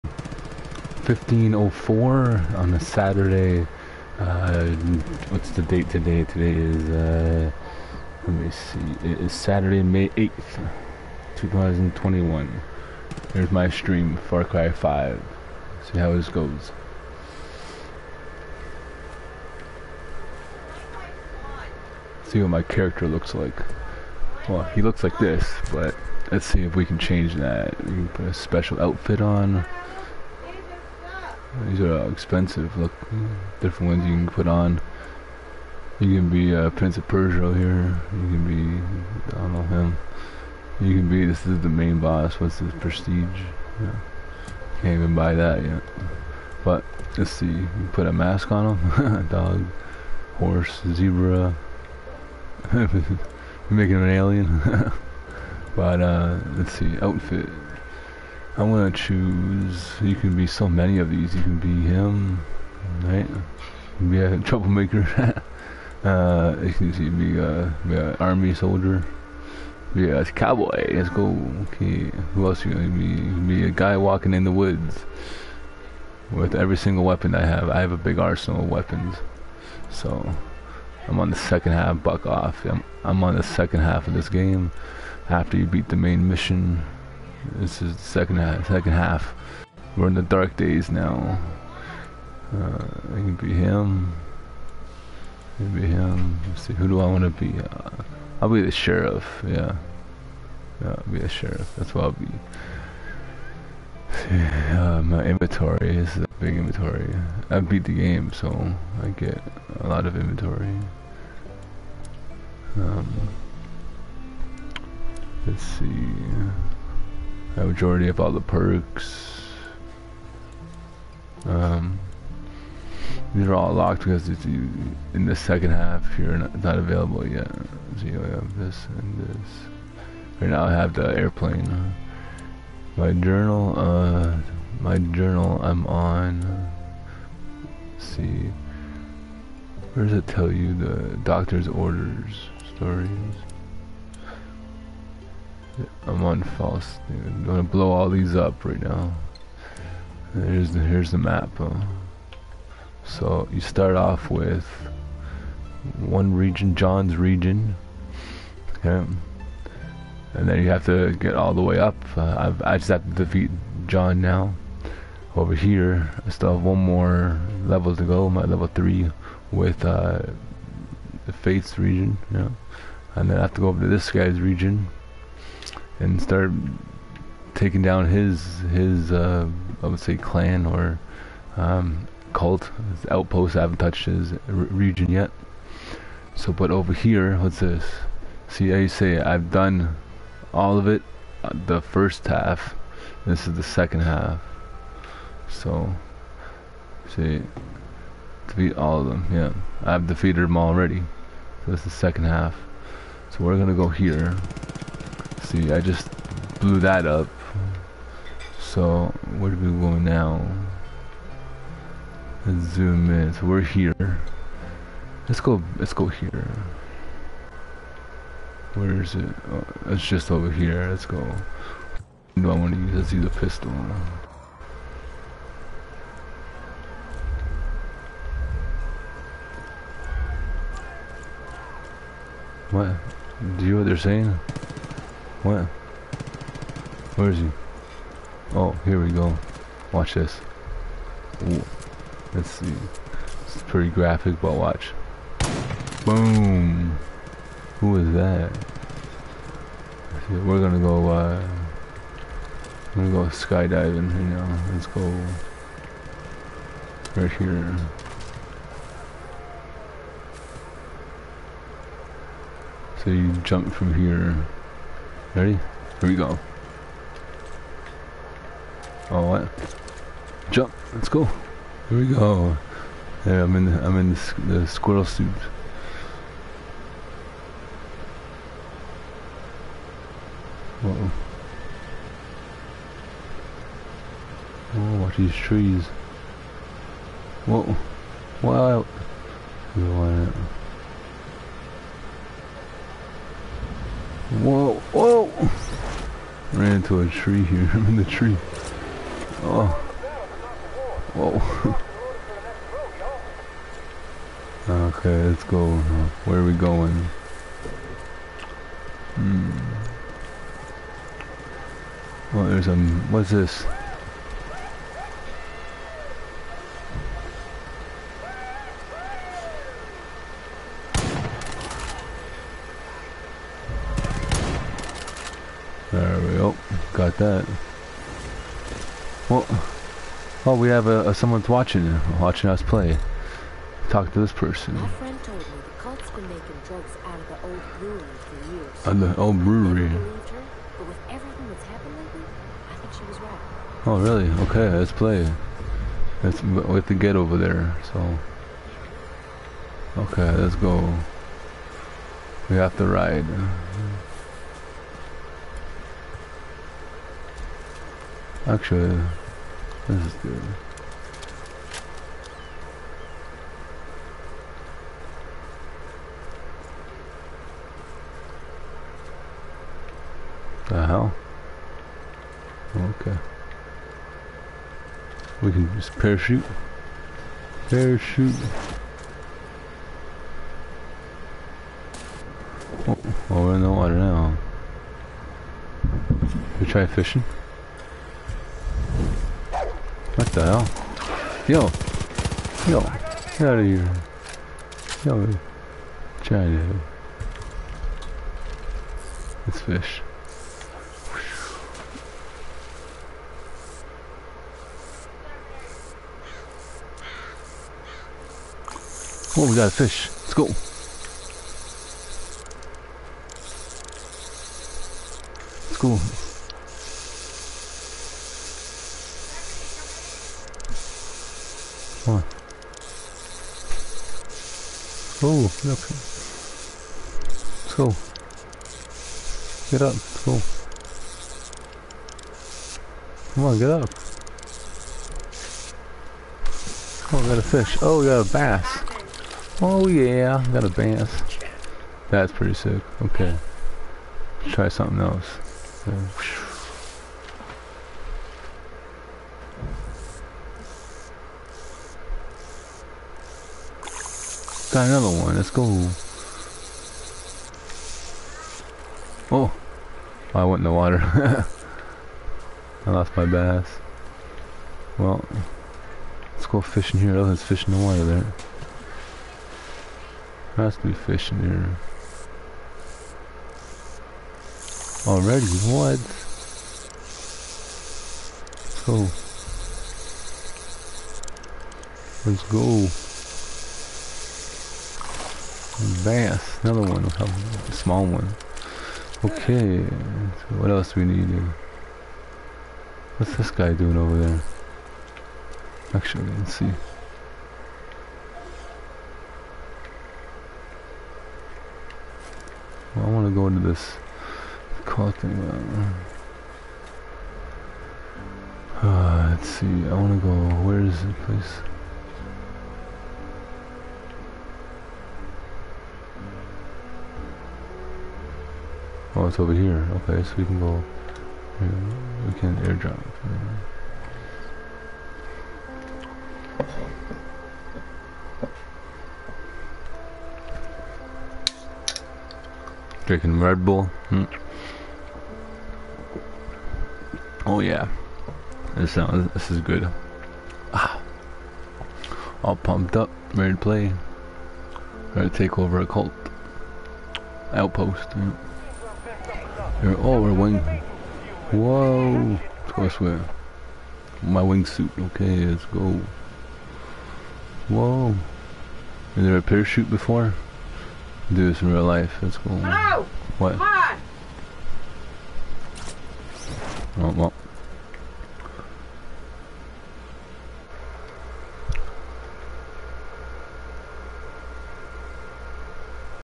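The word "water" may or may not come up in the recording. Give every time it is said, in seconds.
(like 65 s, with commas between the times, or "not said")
383 s, 460 s, 467 s.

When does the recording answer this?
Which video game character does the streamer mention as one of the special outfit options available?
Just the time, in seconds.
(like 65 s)
36 s.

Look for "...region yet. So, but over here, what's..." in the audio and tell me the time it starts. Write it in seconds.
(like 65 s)
184 s.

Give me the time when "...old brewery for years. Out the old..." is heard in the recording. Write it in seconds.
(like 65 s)
337 s.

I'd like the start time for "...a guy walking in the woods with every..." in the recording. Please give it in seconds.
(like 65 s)
73 s.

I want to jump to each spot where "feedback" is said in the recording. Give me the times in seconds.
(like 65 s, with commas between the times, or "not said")
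not said.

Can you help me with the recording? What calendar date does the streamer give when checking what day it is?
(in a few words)
May 8th, 2021.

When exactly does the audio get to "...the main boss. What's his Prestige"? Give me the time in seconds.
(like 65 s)
41 s.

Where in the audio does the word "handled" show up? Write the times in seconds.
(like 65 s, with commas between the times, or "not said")
not said.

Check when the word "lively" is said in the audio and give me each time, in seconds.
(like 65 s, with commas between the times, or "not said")
not said.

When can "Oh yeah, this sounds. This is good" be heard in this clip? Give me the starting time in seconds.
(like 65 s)
537 s.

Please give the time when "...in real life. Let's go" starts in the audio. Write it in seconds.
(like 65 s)
561 s.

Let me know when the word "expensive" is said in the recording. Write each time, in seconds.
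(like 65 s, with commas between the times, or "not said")
32 s.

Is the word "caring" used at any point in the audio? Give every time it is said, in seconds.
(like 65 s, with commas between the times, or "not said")
not said.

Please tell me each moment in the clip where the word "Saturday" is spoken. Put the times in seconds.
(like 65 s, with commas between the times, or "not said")
2 s, 9 s.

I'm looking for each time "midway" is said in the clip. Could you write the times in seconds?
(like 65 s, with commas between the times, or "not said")
not said.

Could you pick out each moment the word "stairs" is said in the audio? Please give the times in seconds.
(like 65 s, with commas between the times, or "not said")
not said.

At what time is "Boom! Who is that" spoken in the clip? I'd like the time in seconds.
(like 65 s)
246 s.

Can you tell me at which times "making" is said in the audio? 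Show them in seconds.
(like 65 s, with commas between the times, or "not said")
53 s, 336 s.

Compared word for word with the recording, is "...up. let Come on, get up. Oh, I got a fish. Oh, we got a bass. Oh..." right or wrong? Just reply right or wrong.
right.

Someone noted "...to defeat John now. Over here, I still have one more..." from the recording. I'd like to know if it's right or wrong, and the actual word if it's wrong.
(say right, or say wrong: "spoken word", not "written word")
right.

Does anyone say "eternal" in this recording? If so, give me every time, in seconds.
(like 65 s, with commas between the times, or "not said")
not said.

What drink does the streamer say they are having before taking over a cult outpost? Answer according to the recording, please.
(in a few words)
Red Bull.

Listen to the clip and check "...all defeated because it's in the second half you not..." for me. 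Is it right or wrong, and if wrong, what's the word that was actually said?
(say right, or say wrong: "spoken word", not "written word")
wrong: "locked", not "defeated".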